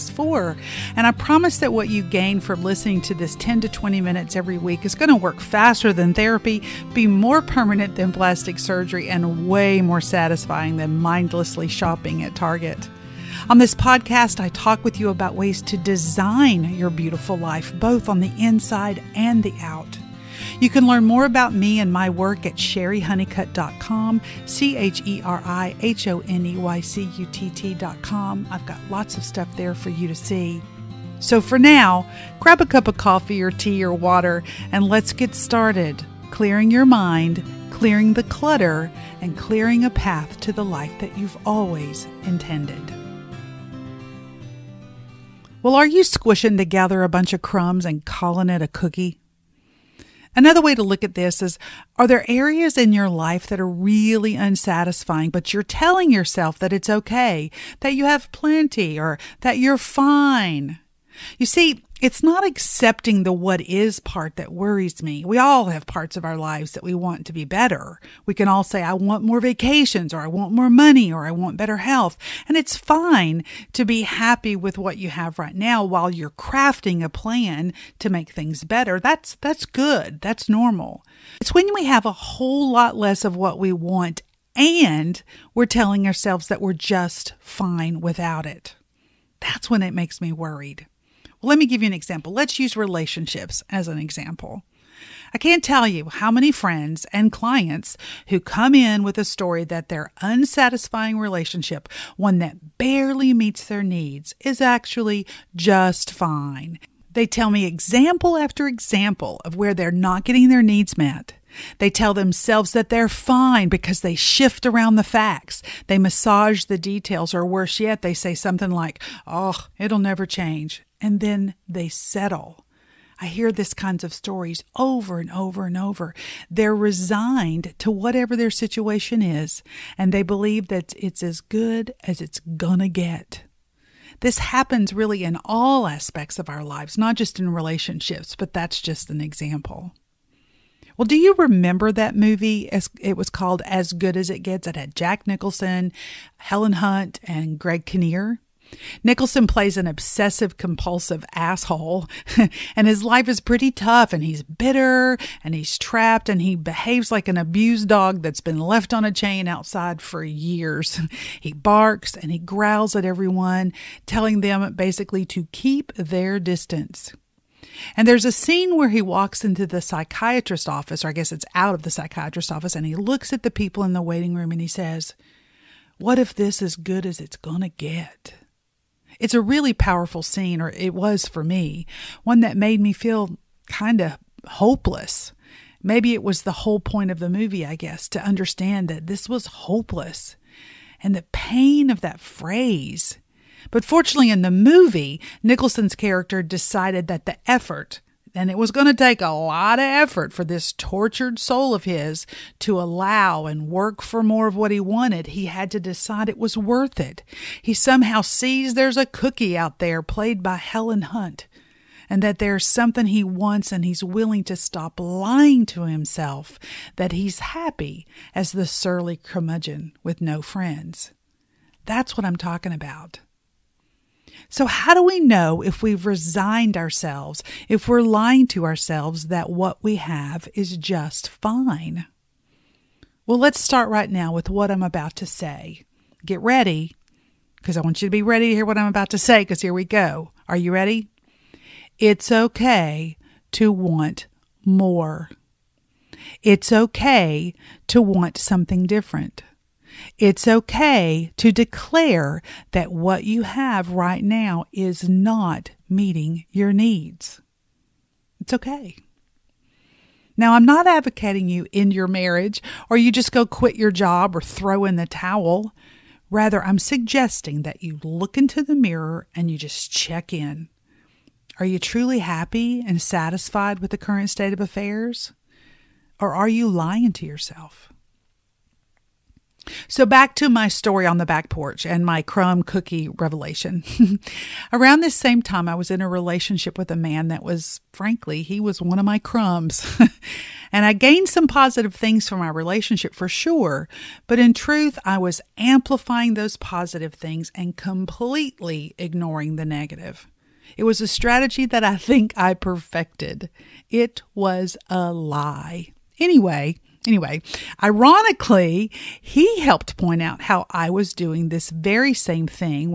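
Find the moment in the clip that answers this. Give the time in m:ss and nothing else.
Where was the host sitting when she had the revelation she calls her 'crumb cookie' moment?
4:41.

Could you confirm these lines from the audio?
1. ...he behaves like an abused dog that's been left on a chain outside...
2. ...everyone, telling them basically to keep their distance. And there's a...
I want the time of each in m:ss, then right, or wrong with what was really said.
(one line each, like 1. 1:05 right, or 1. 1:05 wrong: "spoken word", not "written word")
1. 2:36 right
2. 2:43 right.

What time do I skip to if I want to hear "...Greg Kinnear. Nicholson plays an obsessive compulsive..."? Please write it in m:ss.
2:27.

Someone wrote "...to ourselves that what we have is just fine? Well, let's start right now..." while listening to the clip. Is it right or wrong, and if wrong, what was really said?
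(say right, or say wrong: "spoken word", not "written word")
right.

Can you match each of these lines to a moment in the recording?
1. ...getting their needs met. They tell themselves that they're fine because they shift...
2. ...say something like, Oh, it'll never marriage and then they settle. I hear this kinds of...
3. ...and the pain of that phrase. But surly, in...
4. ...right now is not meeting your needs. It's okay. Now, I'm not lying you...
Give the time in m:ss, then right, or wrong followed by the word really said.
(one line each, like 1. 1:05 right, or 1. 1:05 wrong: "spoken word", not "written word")
1. 1:50 right
2. 1:58 wrong: "change", not "marriage"
3. 3:11 wrong: "fortunately", not "surly"
4. 4:13 wrong: "advocating", not "lying".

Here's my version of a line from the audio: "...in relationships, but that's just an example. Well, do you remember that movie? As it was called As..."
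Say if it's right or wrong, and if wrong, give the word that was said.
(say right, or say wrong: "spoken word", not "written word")
right.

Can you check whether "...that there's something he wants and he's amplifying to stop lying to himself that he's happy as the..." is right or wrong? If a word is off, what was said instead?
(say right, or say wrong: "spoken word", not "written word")
wrong: "willing", not "amplifying".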